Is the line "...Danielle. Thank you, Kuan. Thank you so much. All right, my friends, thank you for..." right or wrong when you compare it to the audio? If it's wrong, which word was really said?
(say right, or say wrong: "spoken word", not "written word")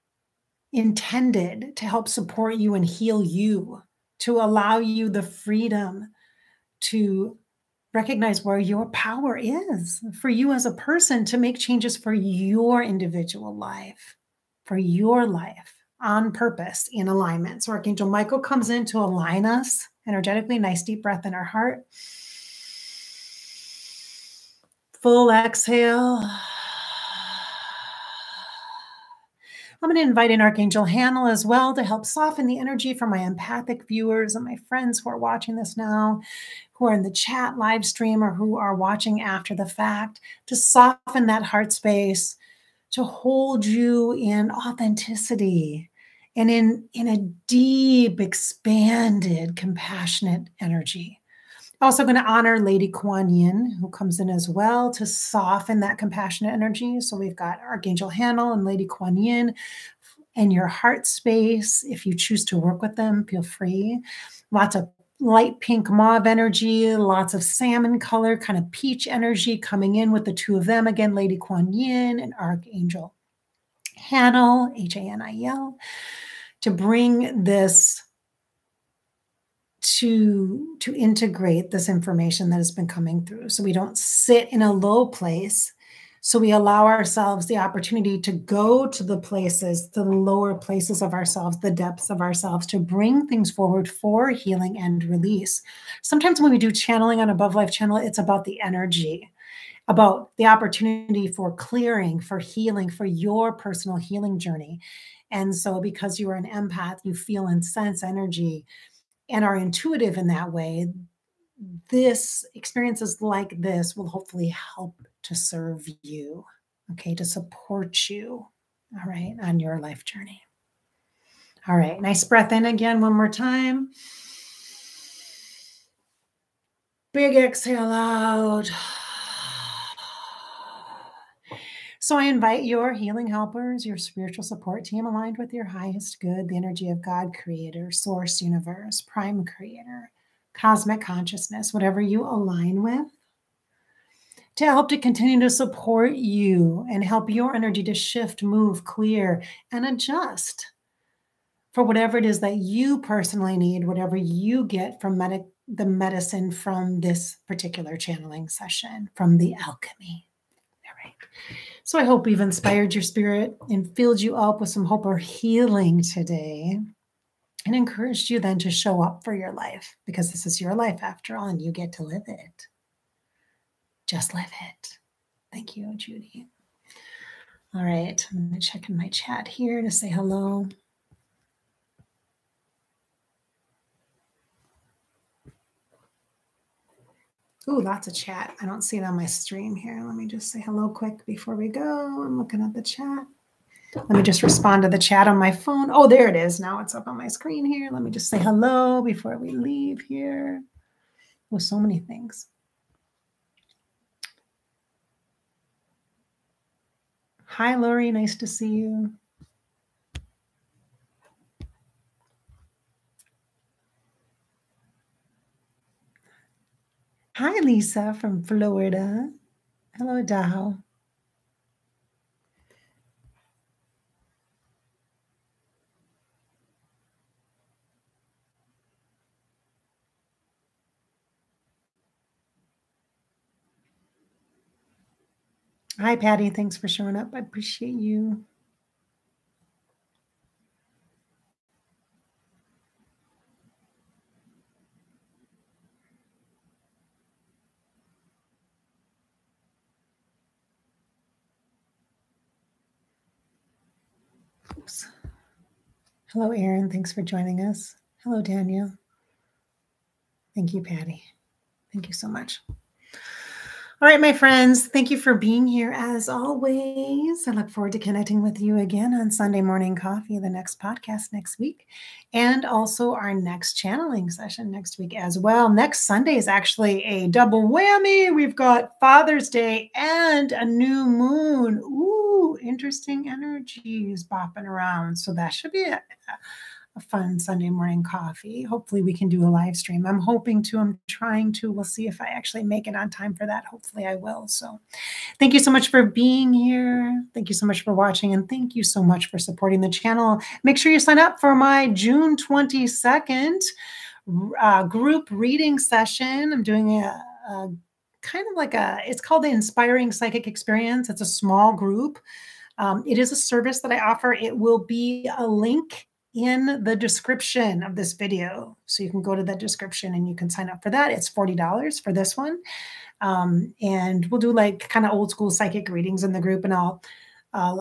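wrong: "Patty", not "Kuan".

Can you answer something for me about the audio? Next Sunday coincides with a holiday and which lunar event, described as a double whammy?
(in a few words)
new moon.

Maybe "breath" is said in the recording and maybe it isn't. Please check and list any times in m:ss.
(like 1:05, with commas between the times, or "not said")
0:21, 2:02.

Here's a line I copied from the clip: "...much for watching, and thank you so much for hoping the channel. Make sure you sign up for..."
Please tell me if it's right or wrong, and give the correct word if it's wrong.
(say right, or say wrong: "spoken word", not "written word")
wrong: "supporting", not "hoping".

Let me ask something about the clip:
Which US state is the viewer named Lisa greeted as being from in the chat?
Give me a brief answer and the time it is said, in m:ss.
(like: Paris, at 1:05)
Florida, at 3:38.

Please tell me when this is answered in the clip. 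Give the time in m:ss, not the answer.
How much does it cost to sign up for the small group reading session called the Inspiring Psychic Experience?
5:21.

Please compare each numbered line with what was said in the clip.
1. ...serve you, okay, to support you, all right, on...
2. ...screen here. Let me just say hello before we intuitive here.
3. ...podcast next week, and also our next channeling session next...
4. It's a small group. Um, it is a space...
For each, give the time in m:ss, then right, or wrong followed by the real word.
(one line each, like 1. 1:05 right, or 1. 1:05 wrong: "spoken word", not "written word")
1. 1:55 right
2. 3:17 wrong: "leave", not "intuitive"
3. 4:30 right
4. 5:11 wrong: "service", not "space".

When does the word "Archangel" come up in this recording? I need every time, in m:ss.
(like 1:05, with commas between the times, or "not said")
0:17, 0:30, 0:57, 1:12.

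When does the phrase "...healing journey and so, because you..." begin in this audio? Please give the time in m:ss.
1:43.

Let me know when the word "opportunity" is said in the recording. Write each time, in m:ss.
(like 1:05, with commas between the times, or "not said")
1:27, 1:40.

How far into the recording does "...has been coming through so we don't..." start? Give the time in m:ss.
1:22.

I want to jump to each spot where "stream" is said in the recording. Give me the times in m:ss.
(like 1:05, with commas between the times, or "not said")
0:37, 3:09, 4:49.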